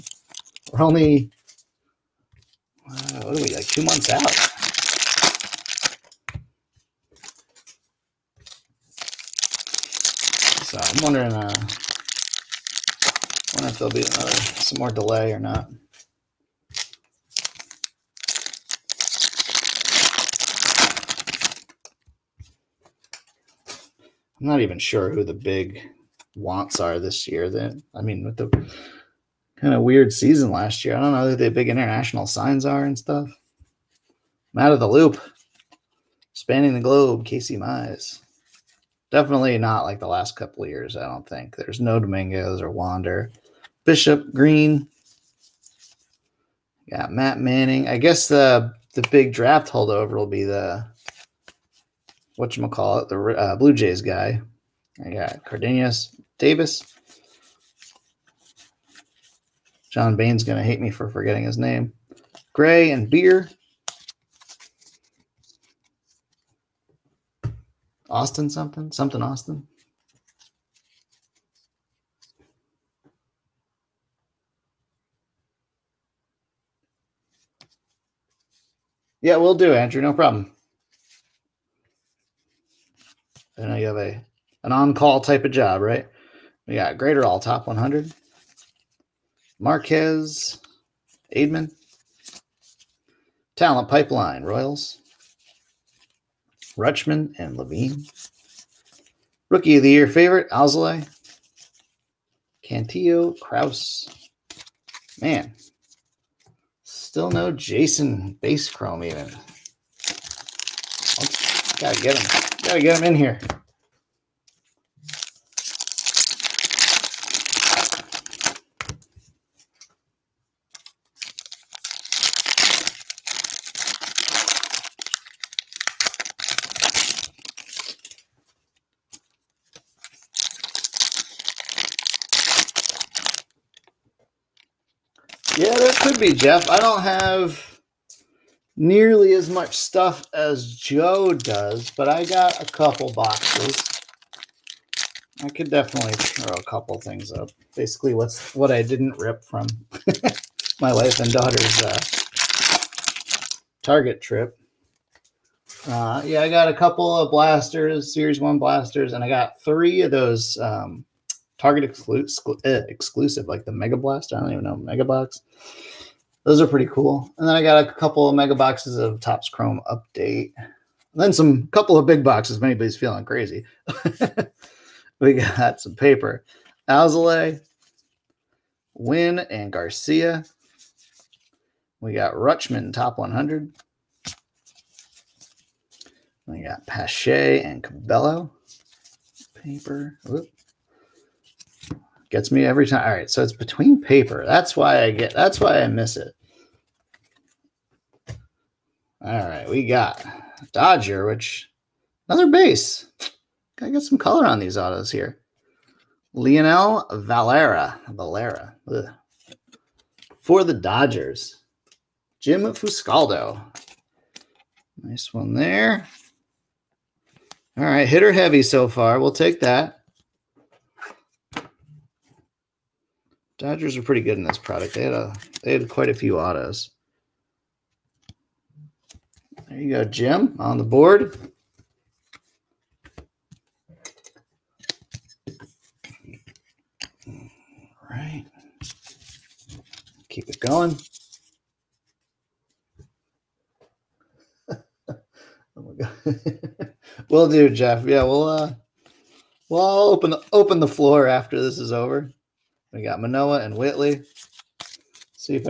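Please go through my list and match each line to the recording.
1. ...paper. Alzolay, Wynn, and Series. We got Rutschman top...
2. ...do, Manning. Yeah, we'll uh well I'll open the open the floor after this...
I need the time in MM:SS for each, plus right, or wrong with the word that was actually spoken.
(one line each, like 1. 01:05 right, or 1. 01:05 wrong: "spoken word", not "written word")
1. 02:55 wrong: "Garcia", not "Series"
2. 04:07 wrong: "Jeff", not "Manning".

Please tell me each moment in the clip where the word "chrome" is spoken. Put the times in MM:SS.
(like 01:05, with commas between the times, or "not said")
01:48, 02:49.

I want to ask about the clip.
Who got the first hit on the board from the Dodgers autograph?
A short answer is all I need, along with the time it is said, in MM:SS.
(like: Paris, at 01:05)
Jim Fuscaldo, at 03:32.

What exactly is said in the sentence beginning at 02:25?
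I could definitely throw a couple things up.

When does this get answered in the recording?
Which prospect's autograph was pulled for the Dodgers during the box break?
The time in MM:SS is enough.
03:26.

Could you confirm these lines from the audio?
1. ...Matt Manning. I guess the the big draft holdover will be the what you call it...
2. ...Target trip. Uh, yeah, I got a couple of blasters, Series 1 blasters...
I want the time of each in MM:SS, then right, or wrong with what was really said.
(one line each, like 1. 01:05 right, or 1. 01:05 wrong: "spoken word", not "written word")
1. 00:47 right
2. 02:33 right.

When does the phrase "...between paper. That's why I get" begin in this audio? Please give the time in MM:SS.
03:13.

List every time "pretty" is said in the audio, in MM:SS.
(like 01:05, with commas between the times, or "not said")
02:46, 03:44.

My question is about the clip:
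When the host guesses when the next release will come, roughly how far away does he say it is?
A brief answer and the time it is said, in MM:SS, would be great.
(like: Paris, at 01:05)
2 months, at 00:03.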